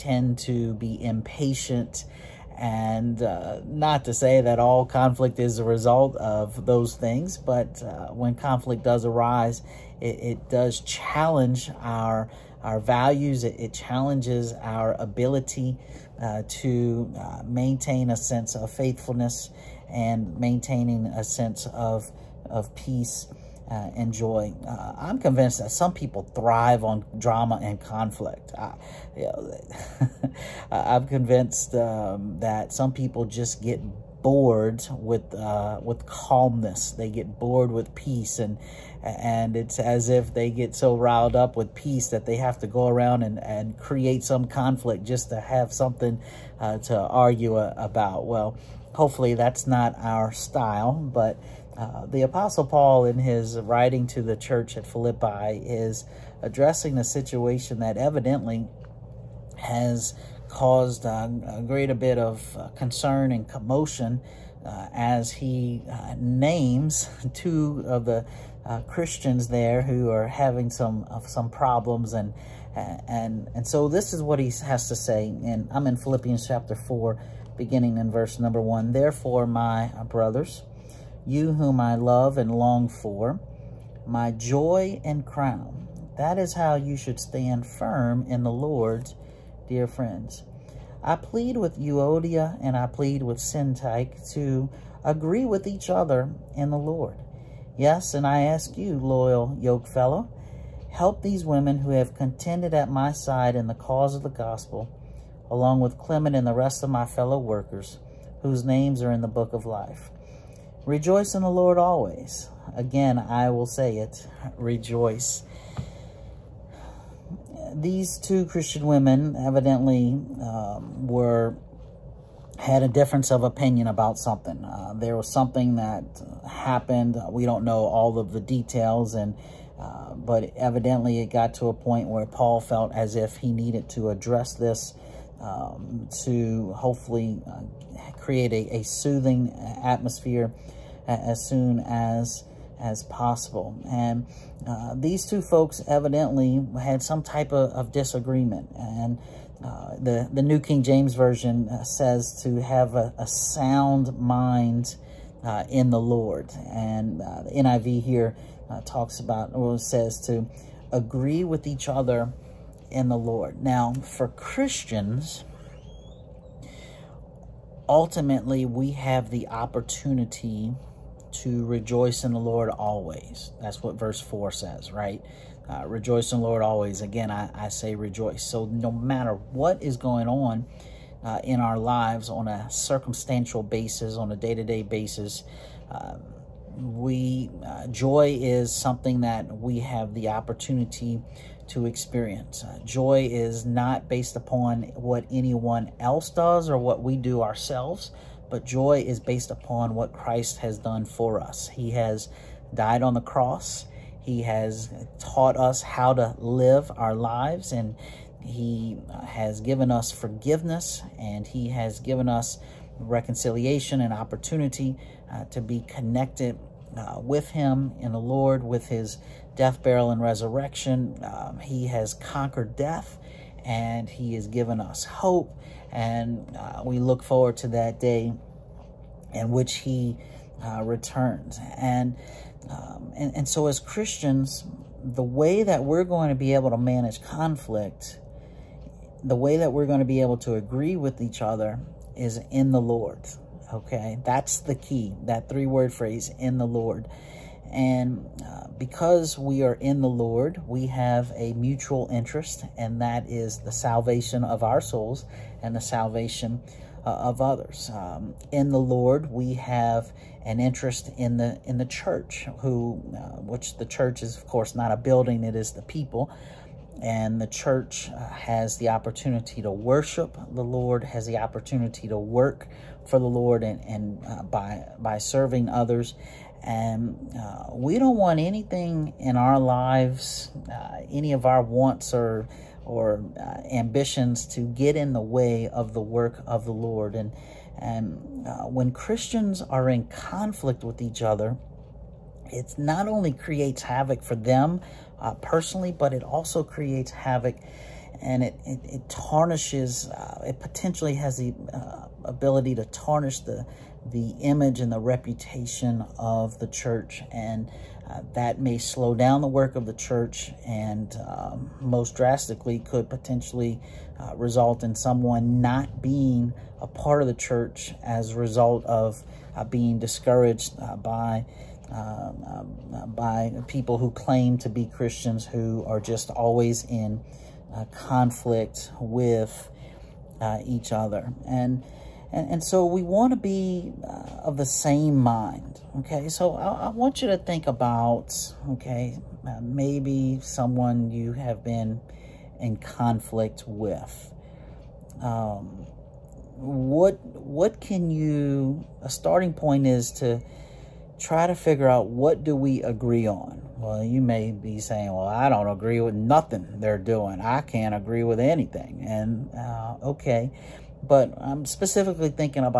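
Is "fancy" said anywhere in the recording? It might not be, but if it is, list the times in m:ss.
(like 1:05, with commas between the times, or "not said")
not said.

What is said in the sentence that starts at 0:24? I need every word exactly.
Uh, I'm convinced that some people thrive on drama and conflict.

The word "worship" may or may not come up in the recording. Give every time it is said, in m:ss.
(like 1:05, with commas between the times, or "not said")
4:29.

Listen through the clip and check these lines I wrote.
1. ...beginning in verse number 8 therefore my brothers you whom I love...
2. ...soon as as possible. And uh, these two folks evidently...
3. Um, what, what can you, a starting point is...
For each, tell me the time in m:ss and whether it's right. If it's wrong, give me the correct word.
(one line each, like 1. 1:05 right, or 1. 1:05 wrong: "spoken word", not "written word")
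1. 1:17 wrong: "1", not "8"
2. 2:21 right
3. 5:45 right.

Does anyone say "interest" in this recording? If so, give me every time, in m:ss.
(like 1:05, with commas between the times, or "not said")
4:12, 4:20.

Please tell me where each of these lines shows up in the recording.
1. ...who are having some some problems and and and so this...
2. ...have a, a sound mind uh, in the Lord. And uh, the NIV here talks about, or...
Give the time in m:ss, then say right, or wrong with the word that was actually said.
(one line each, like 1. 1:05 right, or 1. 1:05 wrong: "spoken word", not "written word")
1. 1:09 right
2. 2:32 right.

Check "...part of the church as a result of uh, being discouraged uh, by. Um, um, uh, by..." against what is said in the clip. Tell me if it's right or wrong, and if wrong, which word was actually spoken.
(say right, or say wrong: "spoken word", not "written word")
right.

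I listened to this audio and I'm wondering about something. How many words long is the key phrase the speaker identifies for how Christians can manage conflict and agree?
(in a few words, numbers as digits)
3.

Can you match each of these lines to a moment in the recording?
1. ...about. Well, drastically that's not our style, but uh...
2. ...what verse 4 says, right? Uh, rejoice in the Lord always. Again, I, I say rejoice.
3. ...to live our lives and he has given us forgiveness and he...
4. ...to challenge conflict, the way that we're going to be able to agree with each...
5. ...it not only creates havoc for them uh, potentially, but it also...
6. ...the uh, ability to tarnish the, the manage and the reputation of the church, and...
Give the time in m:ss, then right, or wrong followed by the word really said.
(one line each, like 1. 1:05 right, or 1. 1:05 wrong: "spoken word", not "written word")
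1. 0:47 wrong: "hopefully", not "drastically"
2. 2:53 right
3. 3:26 right
4. 3:56 wrong: "manage", not "challenge"
5. 4:52 wrong: "personally", not "potentially"
6. 5:01 wrong: "image", not "manage".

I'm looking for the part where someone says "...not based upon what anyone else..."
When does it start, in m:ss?
3:13.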